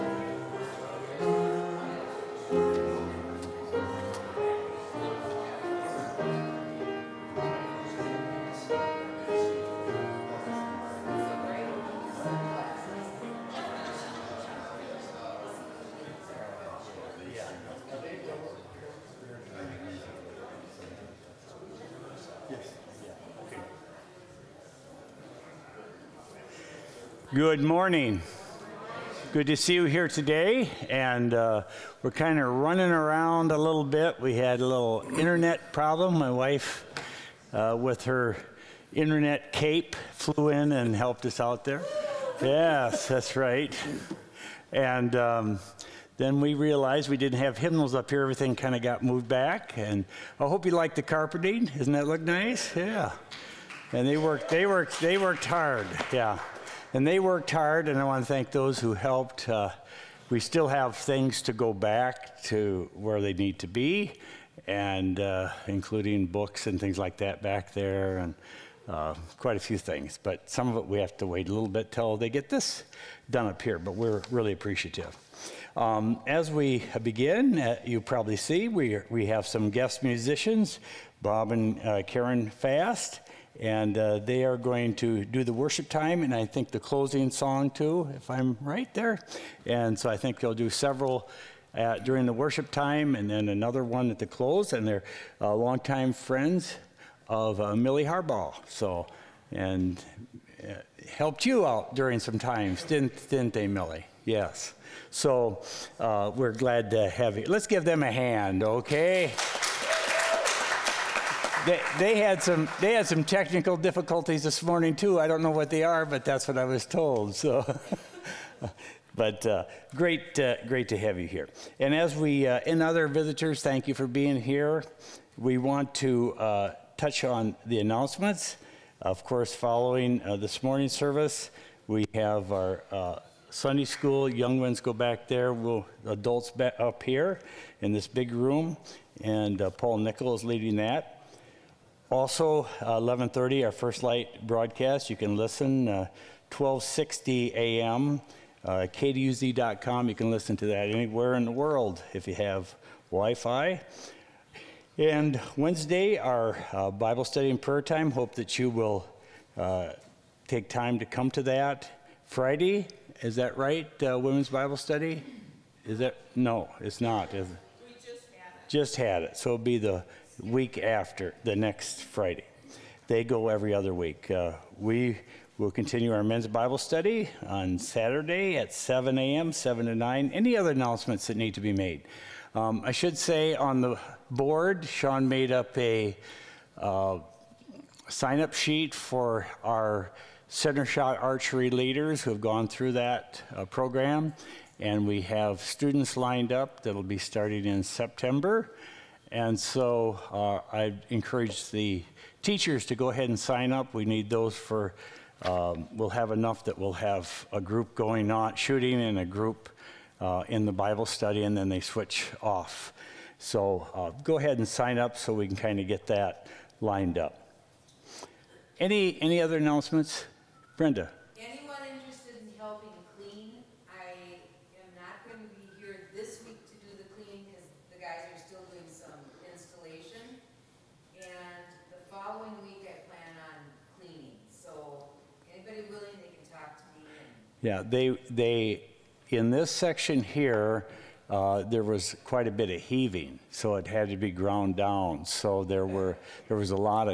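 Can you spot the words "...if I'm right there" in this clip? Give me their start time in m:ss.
1:28.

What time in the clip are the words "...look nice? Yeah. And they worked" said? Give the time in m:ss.
0:52.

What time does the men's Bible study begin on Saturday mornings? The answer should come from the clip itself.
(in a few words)
7 a.m.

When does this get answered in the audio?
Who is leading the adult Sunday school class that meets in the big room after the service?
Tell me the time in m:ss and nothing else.
2:19.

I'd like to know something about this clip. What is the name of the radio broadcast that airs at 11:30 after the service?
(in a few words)
First Light.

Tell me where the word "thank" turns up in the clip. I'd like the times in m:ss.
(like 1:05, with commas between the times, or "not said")
0:58, 2:03.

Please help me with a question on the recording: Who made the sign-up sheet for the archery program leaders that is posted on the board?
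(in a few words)
Sean.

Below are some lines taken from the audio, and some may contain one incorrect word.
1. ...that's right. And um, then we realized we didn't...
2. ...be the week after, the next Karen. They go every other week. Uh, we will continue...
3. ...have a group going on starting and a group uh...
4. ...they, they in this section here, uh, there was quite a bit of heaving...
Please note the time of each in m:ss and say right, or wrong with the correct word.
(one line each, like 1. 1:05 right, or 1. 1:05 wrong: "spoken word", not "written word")
1. 0:43 right
2. 2:49 wrong: "Friday", not "Karen"
3. 3:26 wrong: "shooting", not "starting"
4. 3:57 right.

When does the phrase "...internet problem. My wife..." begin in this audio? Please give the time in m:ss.
0:35.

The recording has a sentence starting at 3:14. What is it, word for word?
And we have students lined up that'll be starting in September.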